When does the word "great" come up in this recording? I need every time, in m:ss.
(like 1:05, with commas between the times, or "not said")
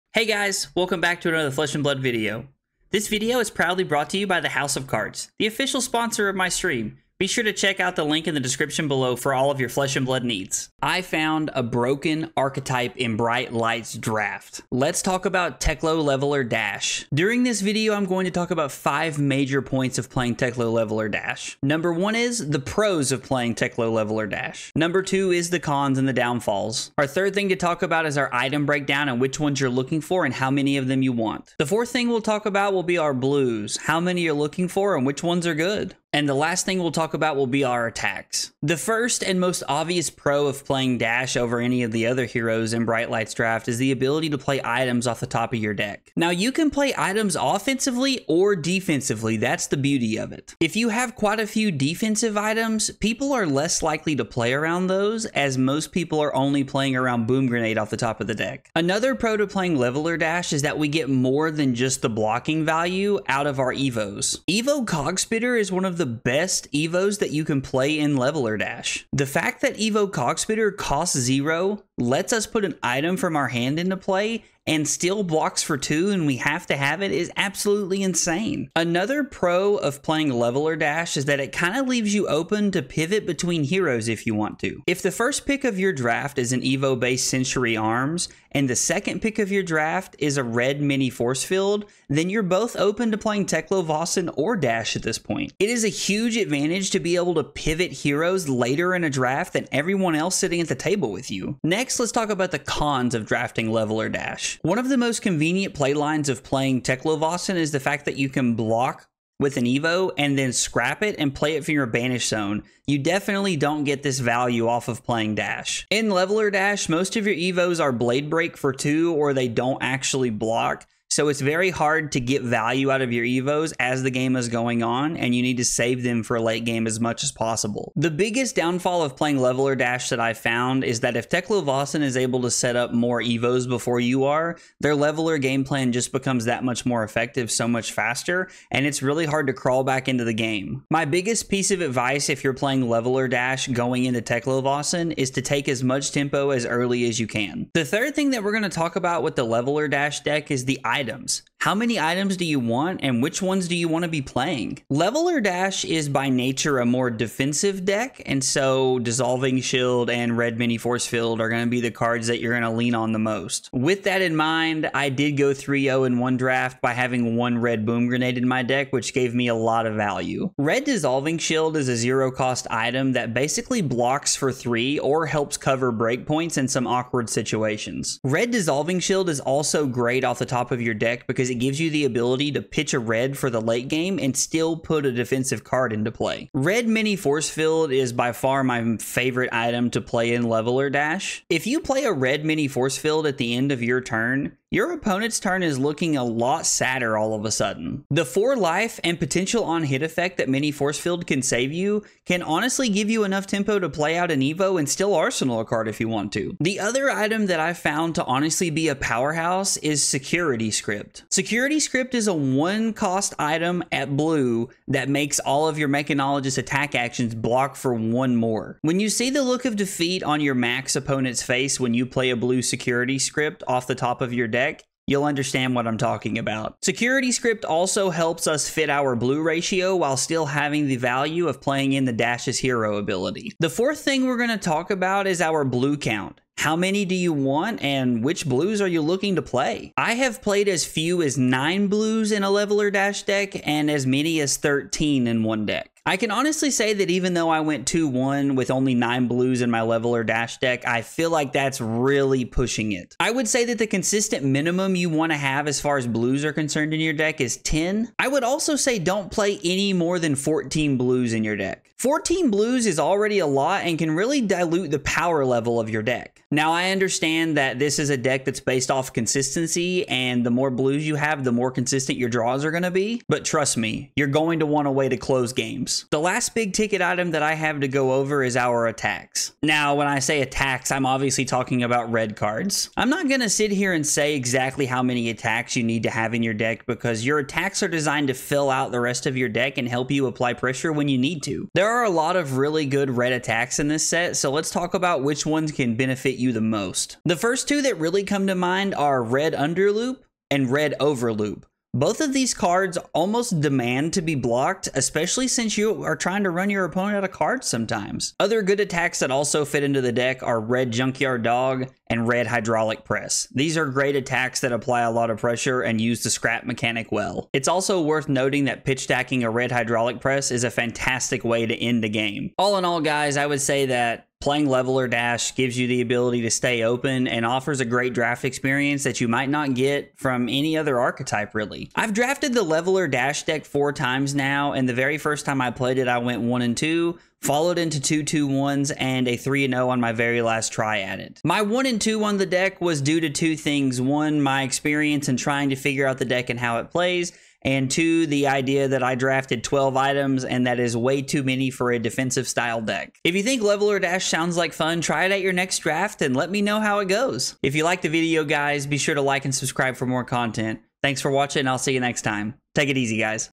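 2:59, 5:13, 5:27.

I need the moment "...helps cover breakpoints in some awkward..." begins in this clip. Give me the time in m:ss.
2:55.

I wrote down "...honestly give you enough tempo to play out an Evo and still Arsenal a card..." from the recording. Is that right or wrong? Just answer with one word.
right.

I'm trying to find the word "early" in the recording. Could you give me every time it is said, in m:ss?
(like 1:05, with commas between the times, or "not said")
2:26.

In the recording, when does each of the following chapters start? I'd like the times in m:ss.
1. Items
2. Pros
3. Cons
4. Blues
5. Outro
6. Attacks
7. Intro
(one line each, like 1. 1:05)
1. 2:27
2. 0:38
3. 1:41
4. 3:53
5. 5:22
6. 4:36
7. 0:10.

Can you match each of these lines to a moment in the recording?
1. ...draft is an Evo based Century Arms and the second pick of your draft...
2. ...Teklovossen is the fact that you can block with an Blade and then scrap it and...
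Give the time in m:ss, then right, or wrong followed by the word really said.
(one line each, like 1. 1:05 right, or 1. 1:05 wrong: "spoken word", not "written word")
1. 1:25 right
2. 1:46 wrong: "Evo", not "Blade".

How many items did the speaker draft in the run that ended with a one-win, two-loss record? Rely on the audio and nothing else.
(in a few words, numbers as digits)
12.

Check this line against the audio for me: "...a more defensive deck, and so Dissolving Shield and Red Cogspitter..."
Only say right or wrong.
wrong.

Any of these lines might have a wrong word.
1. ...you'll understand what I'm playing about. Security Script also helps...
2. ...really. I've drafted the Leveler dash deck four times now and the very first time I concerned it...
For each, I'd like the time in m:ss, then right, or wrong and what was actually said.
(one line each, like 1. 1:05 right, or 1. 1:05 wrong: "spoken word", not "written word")
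1. 3:45 wrong: "talking", not "playing"
2. 5:31 wrong: "played", not "concerned".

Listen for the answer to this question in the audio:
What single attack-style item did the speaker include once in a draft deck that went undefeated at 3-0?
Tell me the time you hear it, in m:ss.
2:47.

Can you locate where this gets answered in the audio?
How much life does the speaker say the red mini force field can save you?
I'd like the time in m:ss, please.
3:18.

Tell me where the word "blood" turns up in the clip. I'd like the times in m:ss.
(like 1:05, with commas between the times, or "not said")
0:01, 0:10.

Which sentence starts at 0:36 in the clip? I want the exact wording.
And the last thing we'll talk about will be our attacks.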